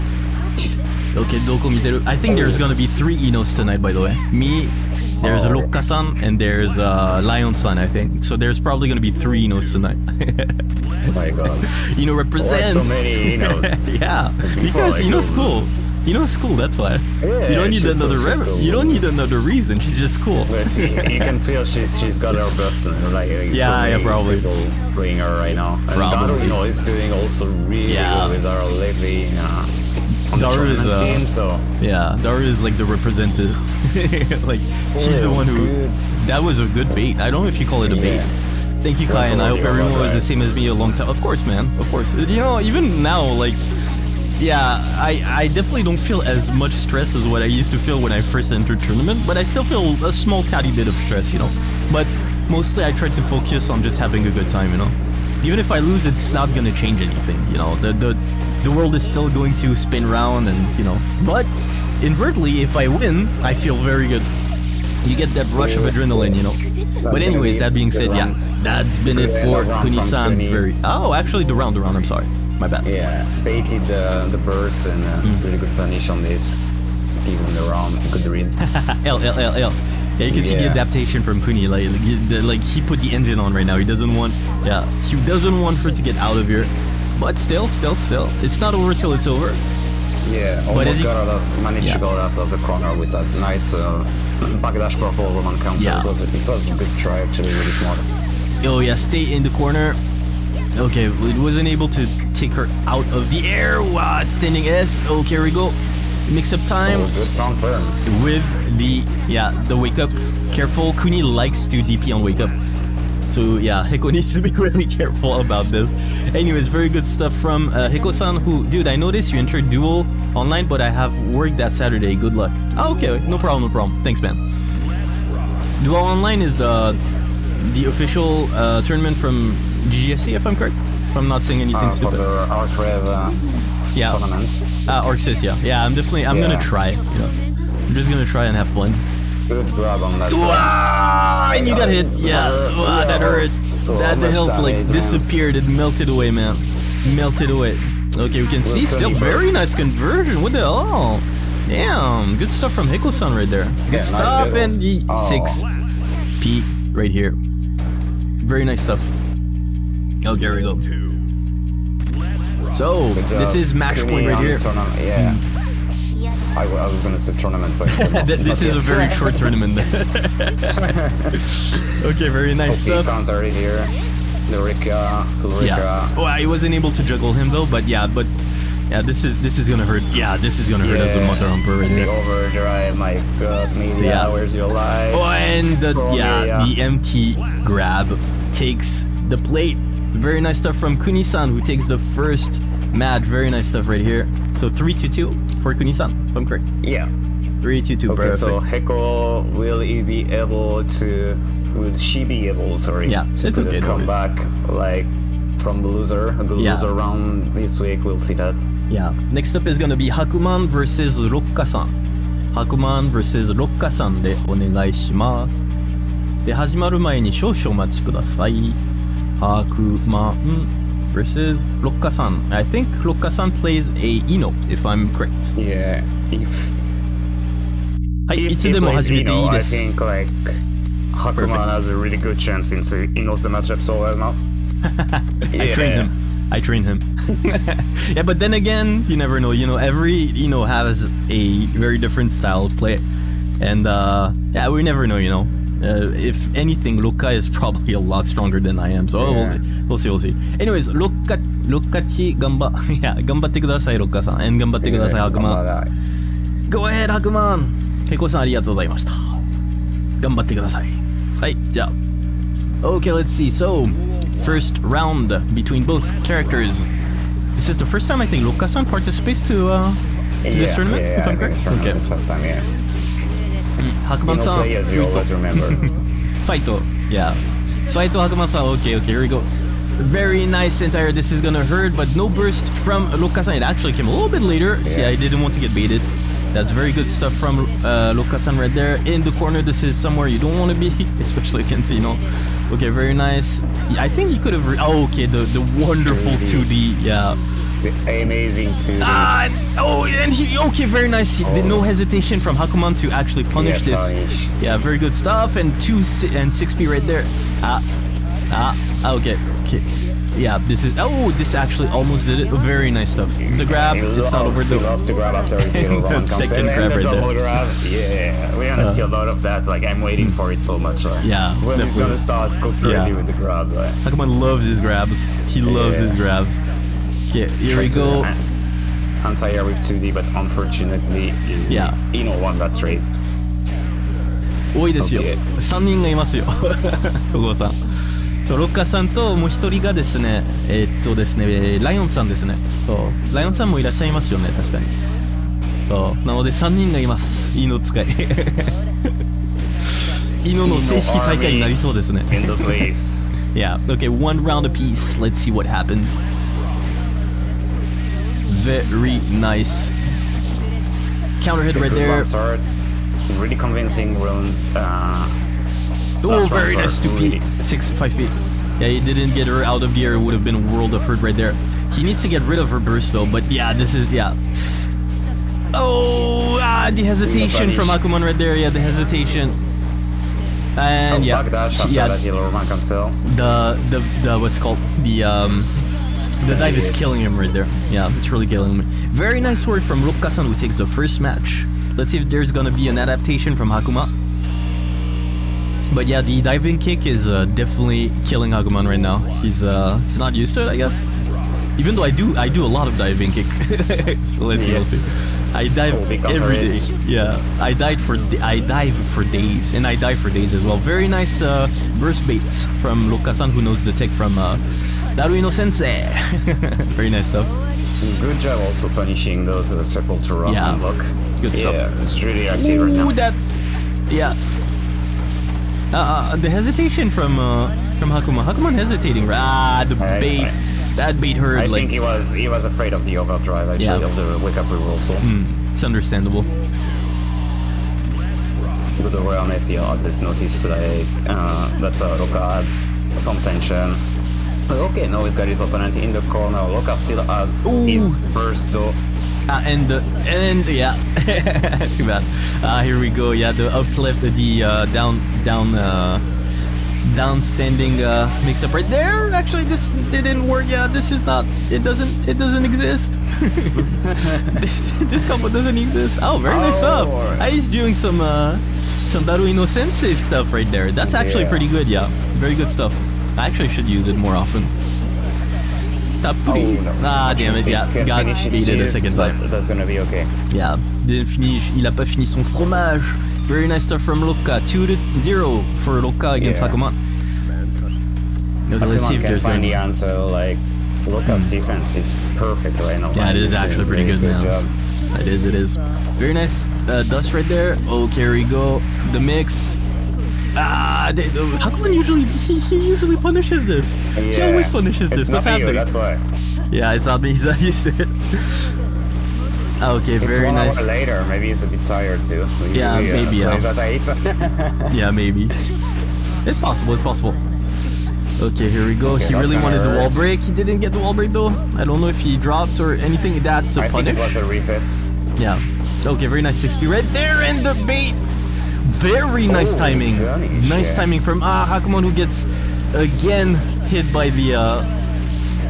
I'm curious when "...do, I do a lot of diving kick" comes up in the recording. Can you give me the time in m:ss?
6:42.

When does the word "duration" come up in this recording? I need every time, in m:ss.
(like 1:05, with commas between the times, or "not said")
not said.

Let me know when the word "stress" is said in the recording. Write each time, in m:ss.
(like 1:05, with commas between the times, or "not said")
0:46, 0:50.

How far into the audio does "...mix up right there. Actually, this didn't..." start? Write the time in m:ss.
7:38.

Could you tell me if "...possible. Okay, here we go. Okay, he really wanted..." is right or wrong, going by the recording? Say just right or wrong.
right.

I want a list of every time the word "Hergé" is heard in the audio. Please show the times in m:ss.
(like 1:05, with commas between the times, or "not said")
not said.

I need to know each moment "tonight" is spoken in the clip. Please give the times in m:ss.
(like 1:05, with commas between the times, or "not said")
0:03, 0:09.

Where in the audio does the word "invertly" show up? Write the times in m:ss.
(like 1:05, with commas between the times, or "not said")
1:02.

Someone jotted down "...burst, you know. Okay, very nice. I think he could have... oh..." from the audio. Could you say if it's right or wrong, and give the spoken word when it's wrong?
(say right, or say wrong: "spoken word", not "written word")
wrong: "against", not "burst".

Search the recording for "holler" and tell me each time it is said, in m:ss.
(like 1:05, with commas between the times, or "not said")
not said.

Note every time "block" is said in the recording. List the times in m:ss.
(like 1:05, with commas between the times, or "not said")
7:00.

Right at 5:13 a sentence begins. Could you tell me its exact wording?
The grab, yeah, it's not over.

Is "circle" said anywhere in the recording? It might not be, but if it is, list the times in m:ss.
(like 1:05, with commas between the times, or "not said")
6:59.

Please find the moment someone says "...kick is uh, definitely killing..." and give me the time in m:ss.
6:36.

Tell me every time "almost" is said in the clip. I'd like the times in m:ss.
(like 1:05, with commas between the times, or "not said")
1:30, 5:11.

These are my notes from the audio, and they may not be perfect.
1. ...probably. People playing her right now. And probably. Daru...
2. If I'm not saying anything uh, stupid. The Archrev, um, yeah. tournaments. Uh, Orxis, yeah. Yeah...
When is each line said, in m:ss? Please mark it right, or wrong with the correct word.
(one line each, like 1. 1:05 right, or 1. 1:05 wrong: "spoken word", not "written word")
1. 0:24 right
2. 2:10 right.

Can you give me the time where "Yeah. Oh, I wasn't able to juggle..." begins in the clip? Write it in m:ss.
2:55.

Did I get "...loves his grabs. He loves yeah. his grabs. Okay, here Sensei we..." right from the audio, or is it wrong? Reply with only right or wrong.
wrong.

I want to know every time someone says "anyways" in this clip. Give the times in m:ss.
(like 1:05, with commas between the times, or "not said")
1:07, 1:56, 4:10.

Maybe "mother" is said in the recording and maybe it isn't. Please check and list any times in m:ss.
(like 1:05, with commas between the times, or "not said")
3:01.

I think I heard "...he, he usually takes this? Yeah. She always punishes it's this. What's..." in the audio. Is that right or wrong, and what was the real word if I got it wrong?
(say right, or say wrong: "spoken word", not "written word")
wrong: "punishes", not "takes".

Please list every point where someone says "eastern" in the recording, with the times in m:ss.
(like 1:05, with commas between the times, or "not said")
not said.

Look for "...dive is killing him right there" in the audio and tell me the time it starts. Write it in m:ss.
6:26.